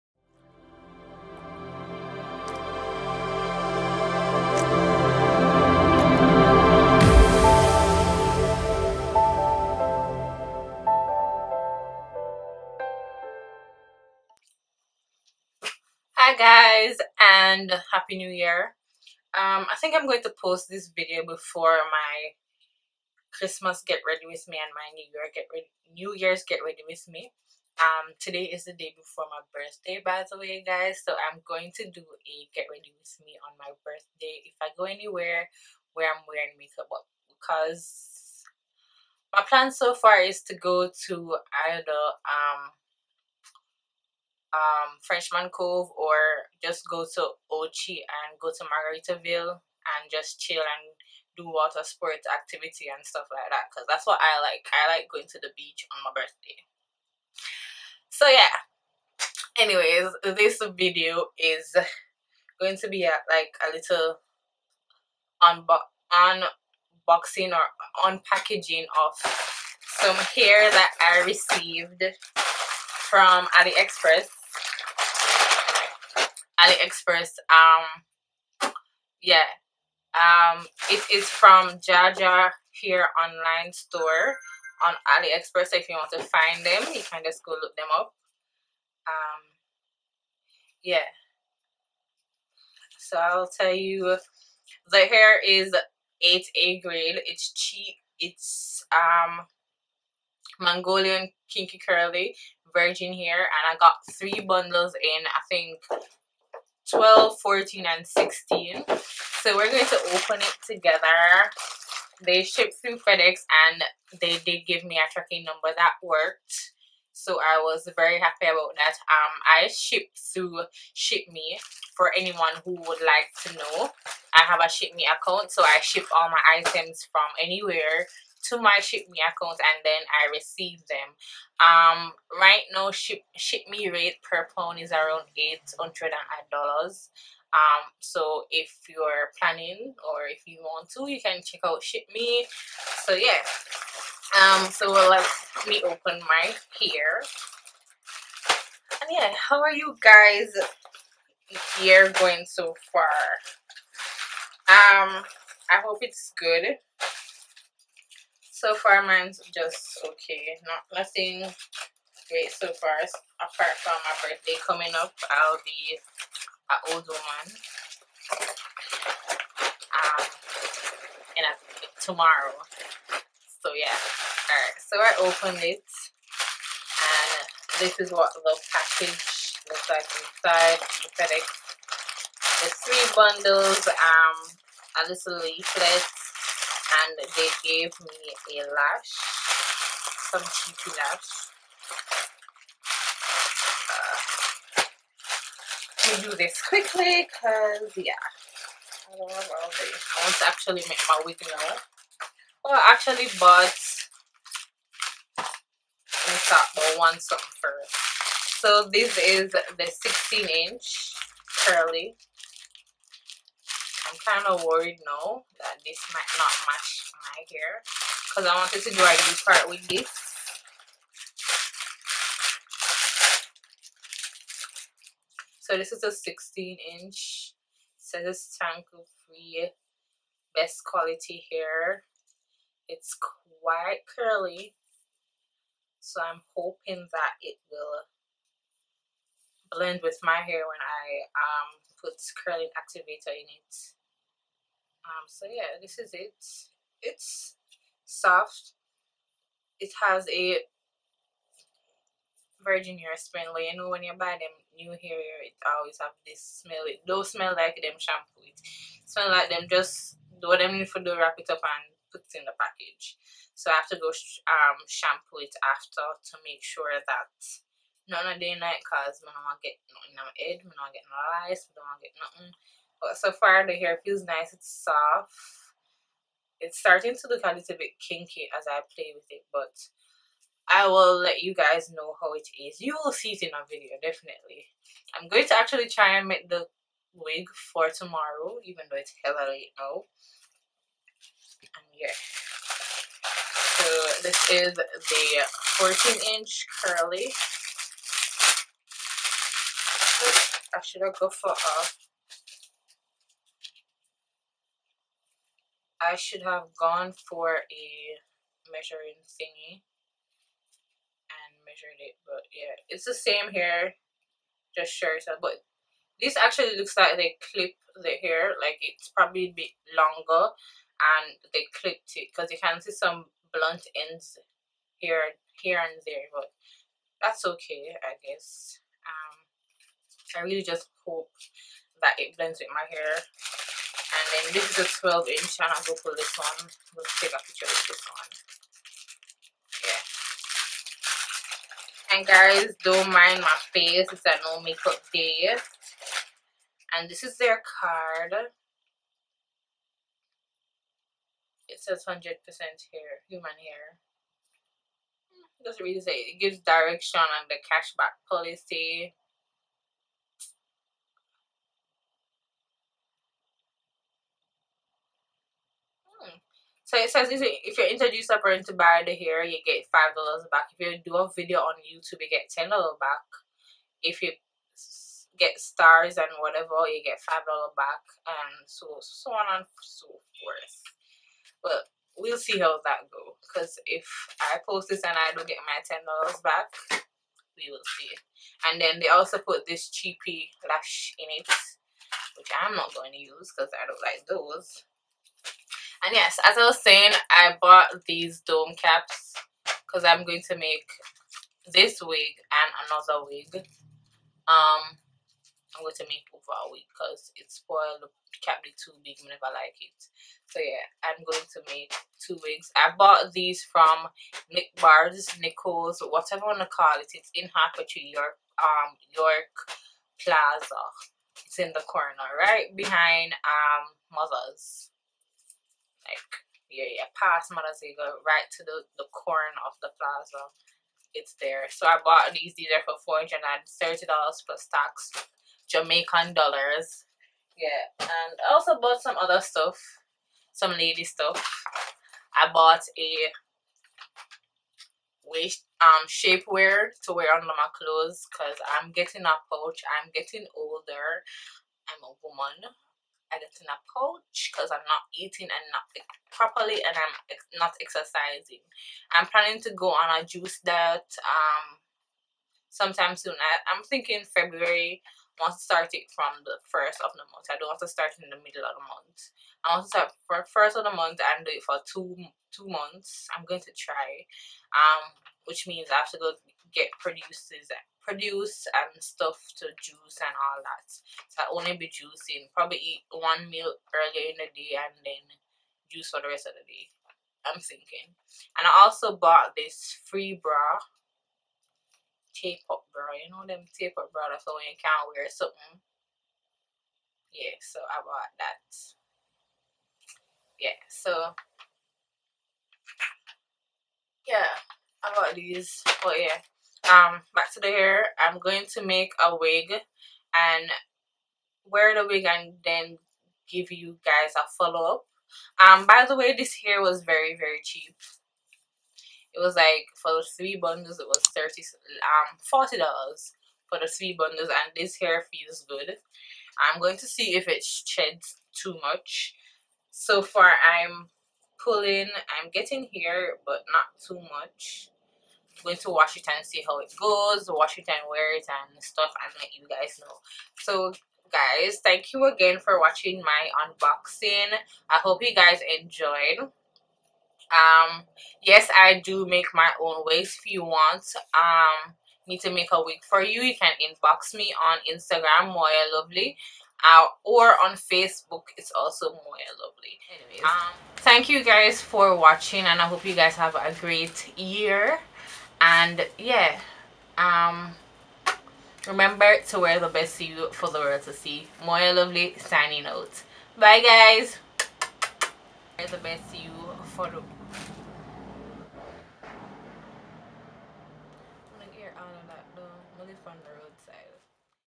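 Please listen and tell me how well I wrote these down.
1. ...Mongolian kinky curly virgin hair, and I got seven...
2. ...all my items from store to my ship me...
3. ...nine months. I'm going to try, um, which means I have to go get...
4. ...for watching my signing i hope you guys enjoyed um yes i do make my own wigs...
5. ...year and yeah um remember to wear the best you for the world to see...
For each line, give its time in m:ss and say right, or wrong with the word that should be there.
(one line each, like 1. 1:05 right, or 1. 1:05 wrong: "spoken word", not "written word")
1. 1:40 wrong: "three", not "seven"
2. 2:06 wrong: "anywhere", not "store"
3. 7:52 wrong: "two", not "nine"
4. 9:02 wrong: "unboxing", not "signing"
5. 9:24 right.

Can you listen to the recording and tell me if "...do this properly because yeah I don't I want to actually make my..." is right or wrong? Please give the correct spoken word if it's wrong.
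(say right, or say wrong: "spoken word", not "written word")
wrong: "quickly", not "properly".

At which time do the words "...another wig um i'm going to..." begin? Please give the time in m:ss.
6:42.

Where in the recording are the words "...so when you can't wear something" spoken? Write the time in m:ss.
8:14.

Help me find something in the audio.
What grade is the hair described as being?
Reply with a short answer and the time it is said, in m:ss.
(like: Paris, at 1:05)
8A, at 1:36.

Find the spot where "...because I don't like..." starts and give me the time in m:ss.
6:33.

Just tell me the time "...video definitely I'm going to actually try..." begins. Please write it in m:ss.
4:43.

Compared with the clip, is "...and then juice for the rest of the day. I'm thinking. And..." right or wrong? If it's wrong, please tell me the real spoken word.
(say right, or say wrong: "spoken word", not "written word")
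right.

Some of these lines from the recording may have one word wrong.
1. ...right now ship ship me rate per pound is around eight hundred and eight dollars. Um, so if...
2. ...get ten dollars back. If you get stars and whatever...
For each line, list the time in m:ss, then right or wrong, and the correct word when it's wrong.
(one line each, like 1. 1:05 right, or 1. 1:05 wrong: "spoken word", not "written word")
1. 2:12 right
2. 6:12 right.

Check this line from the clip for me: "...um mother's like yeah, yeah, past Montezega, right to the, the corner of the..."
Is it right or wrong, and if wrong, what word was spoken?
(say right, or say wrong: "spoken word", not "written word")
right.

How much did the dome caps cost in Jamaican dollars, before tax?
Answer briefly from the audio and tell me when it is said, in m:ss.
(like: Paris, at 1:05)
$430, at 7:13.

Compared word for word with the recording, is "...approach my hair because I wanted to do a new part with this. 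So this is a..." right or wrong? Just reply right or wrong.
wrong.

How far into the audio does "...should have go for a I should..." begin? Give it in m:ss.
5:00.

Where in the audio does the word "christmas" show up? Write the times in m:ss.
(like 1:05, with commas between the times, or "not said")
0:23.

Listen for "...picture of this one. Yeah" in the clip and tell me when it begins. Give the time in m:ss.
5:37.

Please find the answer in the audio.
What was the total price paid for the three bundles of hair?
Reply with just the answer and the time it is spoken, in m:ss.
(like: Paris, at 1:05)
$40, at 8:42.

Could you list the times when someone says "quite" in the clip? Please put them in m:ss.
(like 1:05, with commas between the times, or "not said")
3:53.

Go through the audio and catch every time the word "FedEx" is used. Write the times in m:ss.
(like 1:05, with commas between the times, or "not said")
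1:52, 3:01.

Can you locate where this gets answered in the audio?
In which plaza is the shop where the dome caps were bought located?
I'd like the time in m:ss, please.
6:59.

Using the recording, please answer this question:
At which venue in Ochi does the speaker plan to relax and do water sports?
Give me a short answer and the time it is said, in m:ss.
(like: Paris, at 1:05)
Margaritaville, at 0:48.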